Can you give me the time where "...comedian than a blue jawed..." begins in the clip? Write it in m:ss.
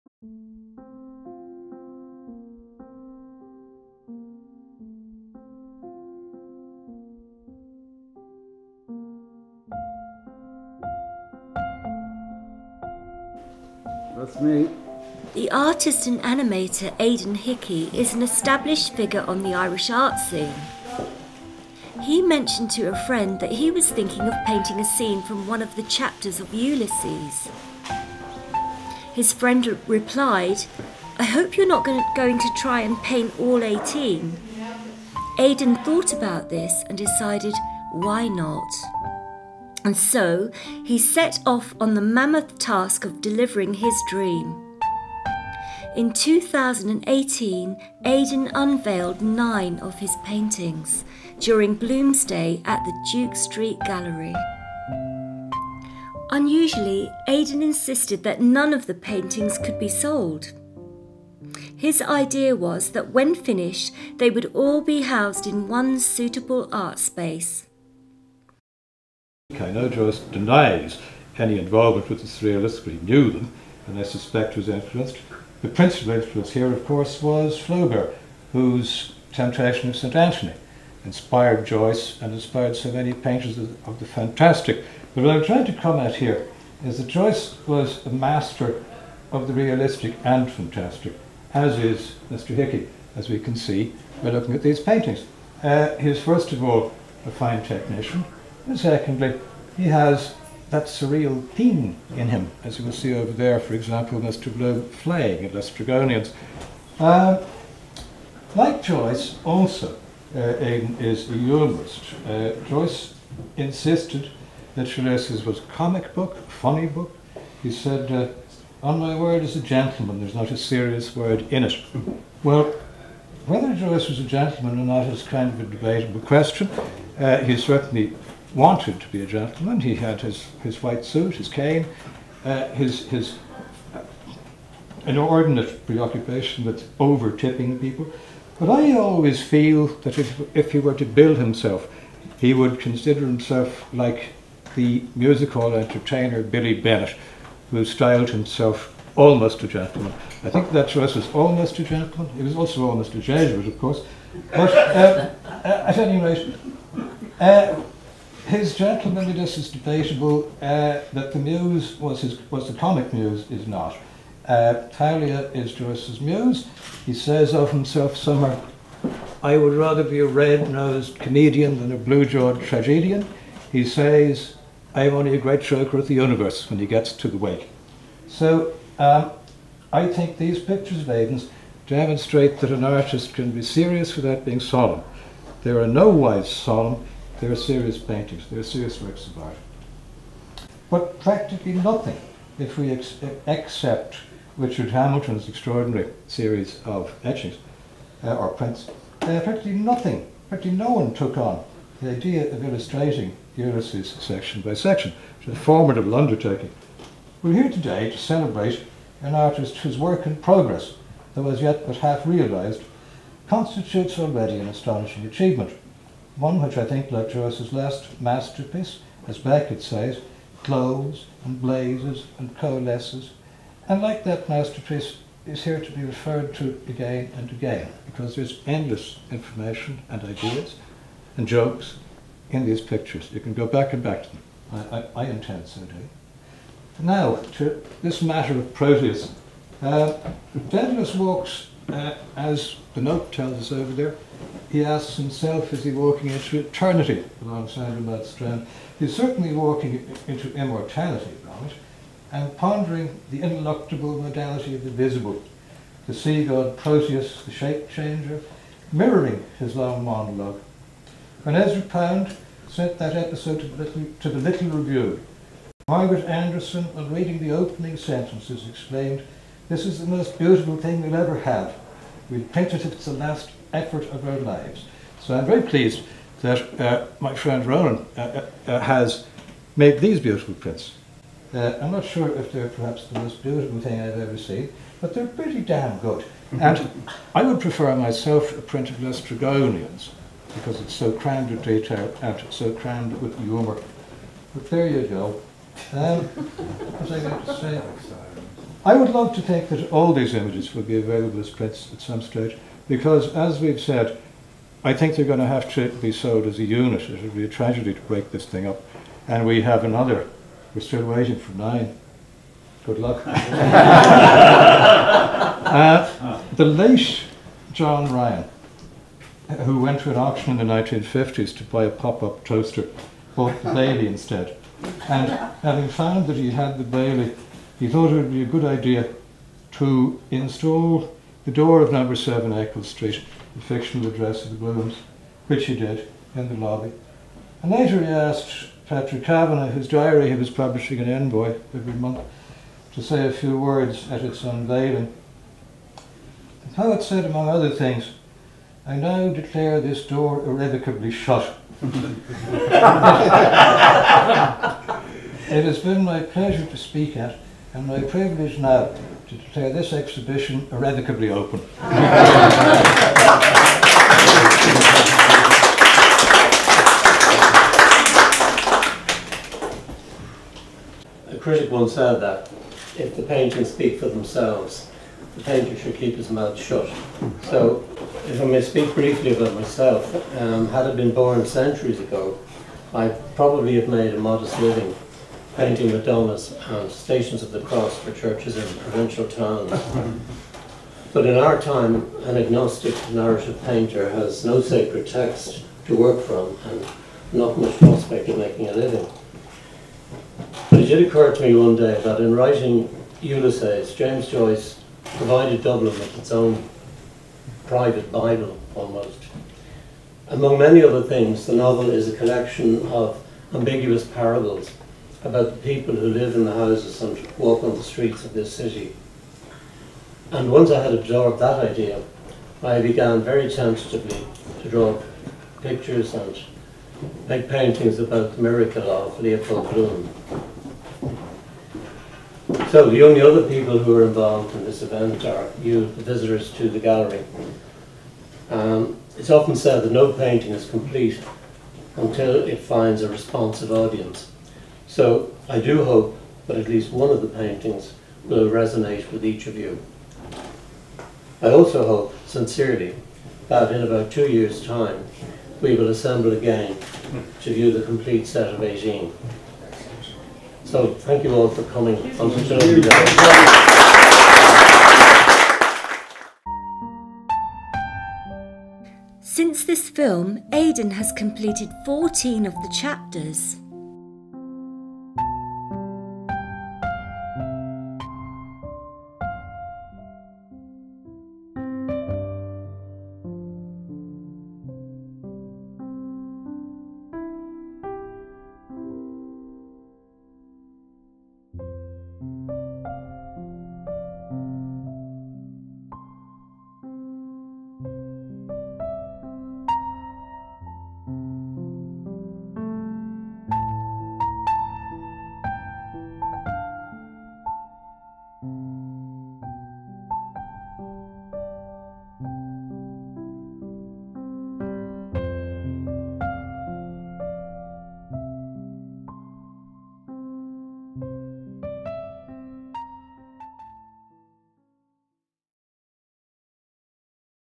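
2:51.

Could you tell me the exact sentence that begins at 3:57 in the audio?
Now, to this matter of Proteus.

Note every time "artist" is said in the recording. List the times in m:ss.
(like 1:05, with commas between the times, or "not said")
0:15, 3:02, 3:29.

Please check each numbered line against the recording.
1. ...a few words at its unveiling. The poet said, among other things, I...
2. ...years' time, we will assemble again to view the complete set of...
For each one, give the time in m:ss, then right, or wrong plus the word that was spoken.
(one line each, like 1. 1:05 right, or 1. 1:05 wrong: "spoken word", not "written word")
1. 5:43 right
2. 7:34 right.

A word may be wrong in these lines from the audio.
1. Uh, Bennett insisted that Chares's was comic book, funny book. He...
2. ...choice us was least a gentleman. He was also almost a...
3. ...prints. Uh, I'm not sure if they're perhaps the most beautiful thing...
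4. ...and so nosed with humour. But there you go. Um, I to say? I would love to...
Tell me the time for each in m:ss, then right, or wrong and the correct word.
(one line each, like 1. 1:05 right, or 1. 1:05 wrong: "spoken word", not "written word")
1. 1:52 wrong: "Joyce", not "Bennett"
2. 2:30 wrong: "almost", not "least"
3. 4:40 right
4. 4:52 wrong: "crammed", not "nosed".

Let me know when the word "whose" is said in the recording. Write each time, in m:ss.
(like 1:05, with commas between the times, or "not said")
1:18, 3:29, 5:39.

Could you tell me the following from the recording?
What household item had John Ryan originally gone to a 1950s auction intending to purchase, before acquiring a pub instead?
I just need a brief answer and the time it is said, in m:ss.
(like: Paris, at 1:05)
pop-up toaster, at 5:21.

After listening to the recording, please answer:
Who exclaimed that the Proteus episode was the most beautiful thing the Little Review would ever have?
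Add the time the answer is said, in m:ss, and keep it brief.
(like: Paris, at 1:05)
Margaret Anderson, at 4:25.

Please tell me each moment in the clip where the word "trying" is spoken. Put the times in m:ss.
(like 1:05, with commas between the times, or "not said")
1:25.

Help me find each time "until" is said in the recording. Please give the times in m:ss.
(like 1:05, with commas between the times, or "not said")
7:21.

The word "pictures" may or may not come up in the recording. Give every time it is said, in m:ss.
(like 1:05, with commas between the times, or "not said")
3:00, 3:52, 7:05.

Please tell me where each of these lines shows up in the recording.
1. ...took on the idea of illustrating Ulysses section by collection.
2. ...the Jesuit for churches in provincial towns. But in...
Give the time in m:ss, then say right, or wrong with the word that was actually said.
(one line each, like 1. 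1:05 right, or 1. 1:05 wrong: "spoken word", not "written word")
1. 3:21 wrong: "section", not "collection"
2. 6:27 wrong: "Cross", not "Jesuit".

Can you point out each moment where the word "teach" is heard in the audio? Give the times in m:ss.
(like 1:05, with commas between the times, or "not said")
not said.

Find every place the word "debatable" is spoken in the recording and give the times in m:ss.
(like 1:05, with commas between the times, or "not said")
2:05, 2:39.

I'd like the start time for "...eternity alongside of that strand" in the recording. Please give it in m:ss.
4:06.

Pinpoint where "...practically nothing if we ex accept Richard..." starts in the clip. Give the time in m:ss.
3:11.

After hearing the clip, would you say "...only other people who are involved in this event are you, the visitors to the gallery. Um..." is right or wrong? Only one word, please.
right.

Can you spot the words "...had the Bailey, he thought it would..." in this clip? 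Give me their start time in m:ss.
5:26.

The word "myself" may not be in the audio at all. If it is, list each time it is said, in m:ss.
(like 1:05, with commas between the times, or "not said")
4:47, 6:19.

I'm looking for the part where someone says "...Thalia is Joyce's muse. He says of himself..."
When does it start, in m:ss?
2:44.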